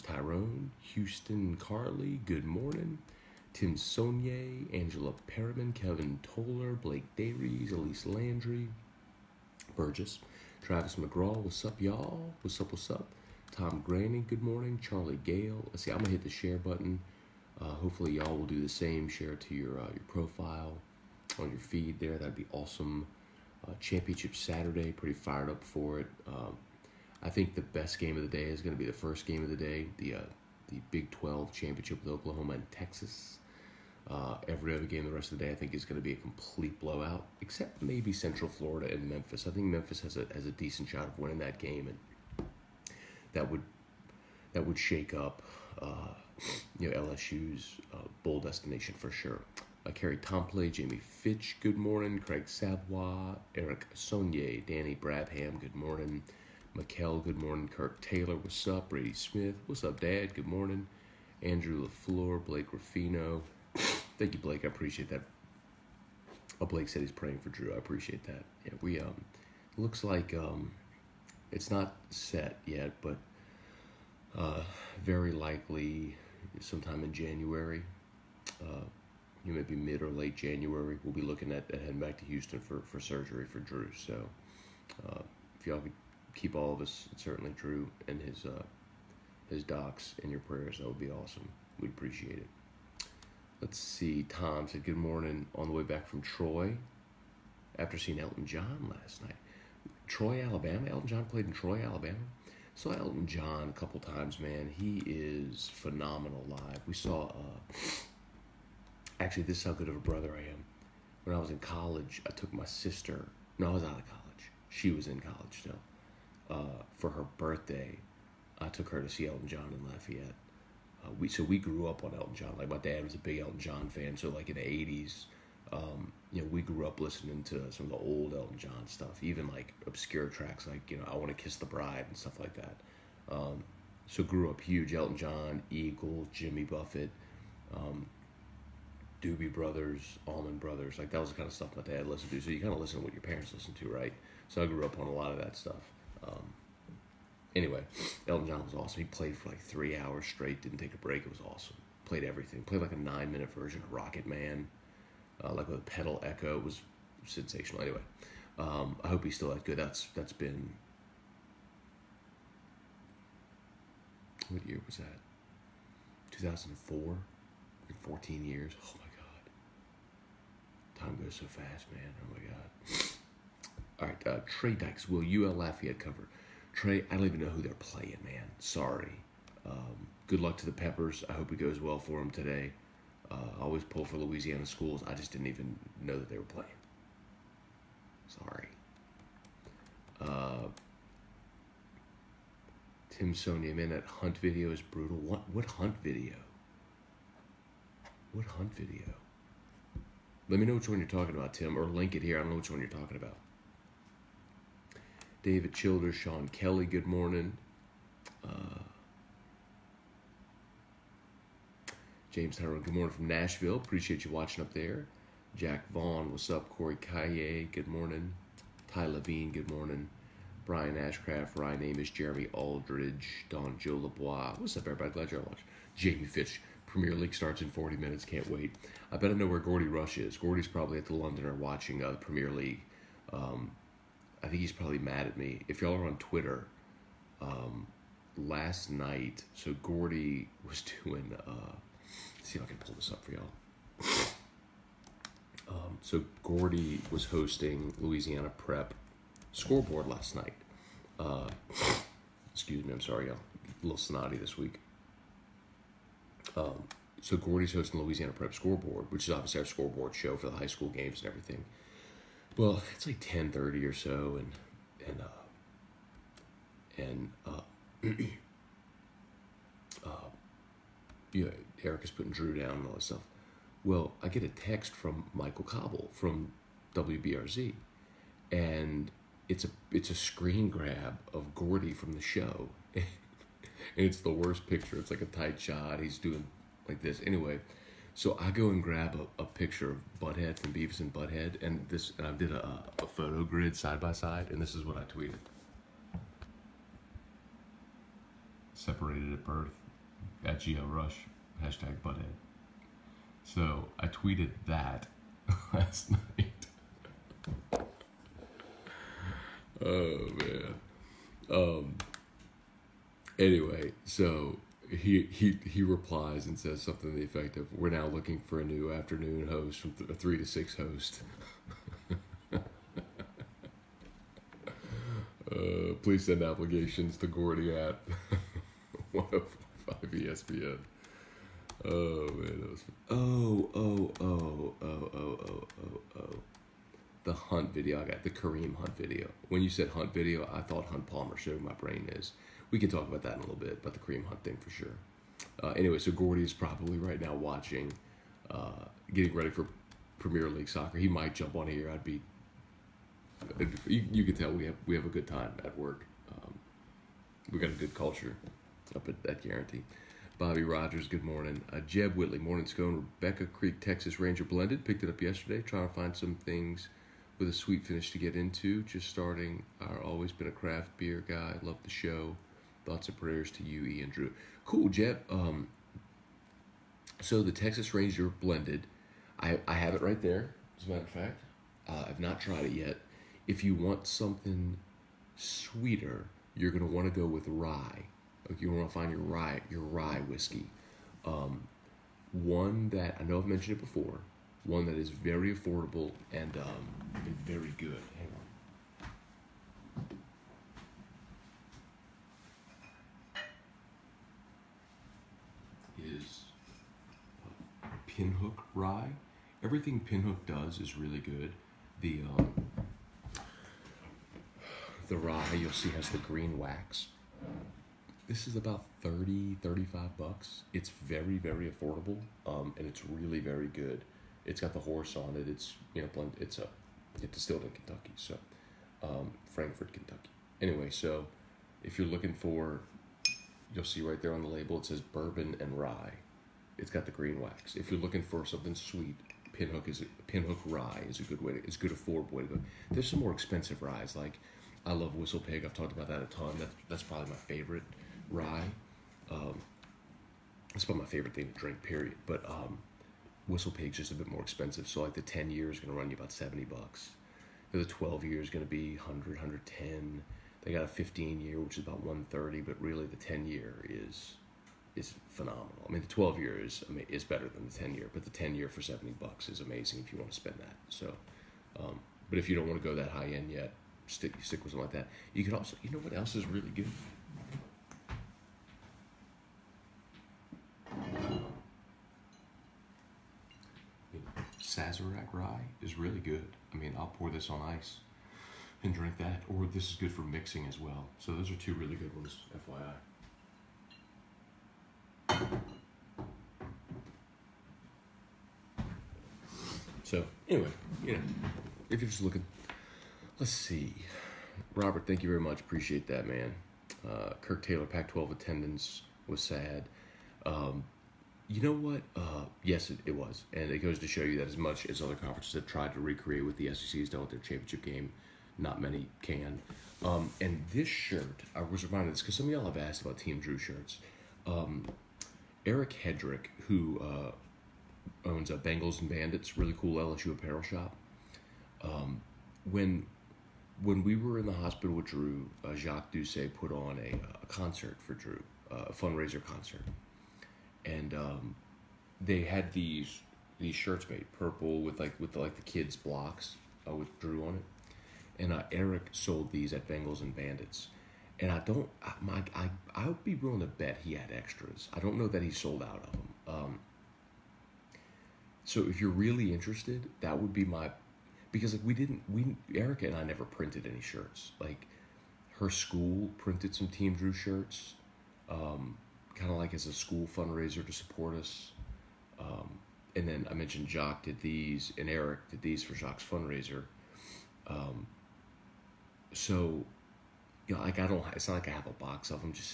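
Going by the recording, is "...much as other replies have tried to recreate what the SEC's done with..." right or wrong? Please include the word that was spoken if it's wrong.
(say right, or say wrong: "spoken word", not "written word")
wrong: "conferences", not "replies".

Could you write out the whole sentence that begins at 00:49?
Uh, Kerry Tompley, Jamie Fitch, good morning.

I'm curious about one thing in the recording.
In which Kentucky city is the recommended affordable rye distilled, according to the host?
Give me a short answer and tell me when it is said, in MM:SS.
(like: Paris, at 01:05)
Frankfort, at 07:09.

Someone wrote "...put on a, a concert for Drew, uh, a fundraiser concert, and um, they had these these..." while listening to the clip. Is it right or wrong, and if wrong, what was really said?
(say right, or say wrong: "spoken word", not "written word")
right.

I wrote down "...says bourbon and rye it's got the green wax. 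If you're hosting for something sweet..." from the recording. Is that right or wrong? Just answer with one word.
wrong.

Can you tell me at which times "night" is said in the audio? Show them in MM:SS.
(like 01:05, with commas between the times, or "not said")
01:39, 03:58, 04:10, 05:06.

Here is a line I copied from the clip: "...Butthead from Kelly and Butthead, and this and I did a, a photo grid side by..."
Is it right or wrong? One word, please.
wrong.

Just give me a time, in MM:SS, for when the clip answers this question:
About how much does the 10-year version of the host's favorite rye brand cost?
07:36.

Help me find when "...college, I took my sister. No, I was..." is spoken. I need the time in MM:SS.
01:51.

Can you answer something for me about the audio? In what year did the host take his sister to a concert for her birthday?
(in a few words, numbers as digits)
2004.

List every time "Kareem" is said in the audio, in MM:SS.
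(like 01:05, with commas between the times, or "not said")
05:38, 05:43.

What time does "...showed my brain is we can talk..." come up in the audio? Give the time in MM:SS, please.
05:41.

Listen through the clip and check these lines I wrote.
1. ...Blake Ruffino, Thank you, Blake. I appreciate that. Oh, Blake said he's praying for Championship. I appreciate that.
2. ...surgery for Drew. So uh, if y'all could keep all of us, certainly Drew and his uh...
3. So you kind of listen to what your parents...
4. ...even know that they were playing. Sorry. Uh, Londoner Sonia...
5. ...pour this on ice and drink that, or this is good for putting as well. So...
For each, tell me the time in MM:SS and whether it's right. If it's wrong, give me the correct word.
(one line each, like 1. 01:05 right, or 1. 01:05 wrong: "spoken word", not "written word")
1. 01:02 wrong: "Drew", not "Championship"
2. 01:23 right
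3. 02:22 right
4. 03:05 wrong: "Tim", not "Londoner"
5. 08:07 wrong: "mixing", not "putting".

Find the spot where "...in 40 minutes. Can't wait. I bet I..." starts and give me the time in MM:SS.
03:47.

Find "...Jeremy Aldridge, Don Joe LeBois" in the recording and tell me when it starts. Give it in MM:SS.
03:42.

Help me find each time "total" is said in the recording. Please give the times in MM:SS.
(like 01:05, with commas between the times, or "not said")
not said.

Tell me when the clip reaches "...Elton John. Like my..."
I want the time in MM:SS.
02:02.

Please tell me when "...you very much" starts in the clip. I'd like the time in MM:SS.
08:25.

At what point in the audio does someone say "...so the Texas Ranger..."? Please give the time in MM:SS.
06:17.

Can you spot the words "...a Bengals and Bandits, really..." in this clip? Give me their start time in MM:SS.
08:48.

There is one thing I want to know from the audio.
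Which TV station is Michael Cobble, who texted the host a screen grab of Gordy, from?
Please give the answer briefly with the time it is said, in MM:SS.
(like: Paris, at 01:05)
WBRZ, at 04:36.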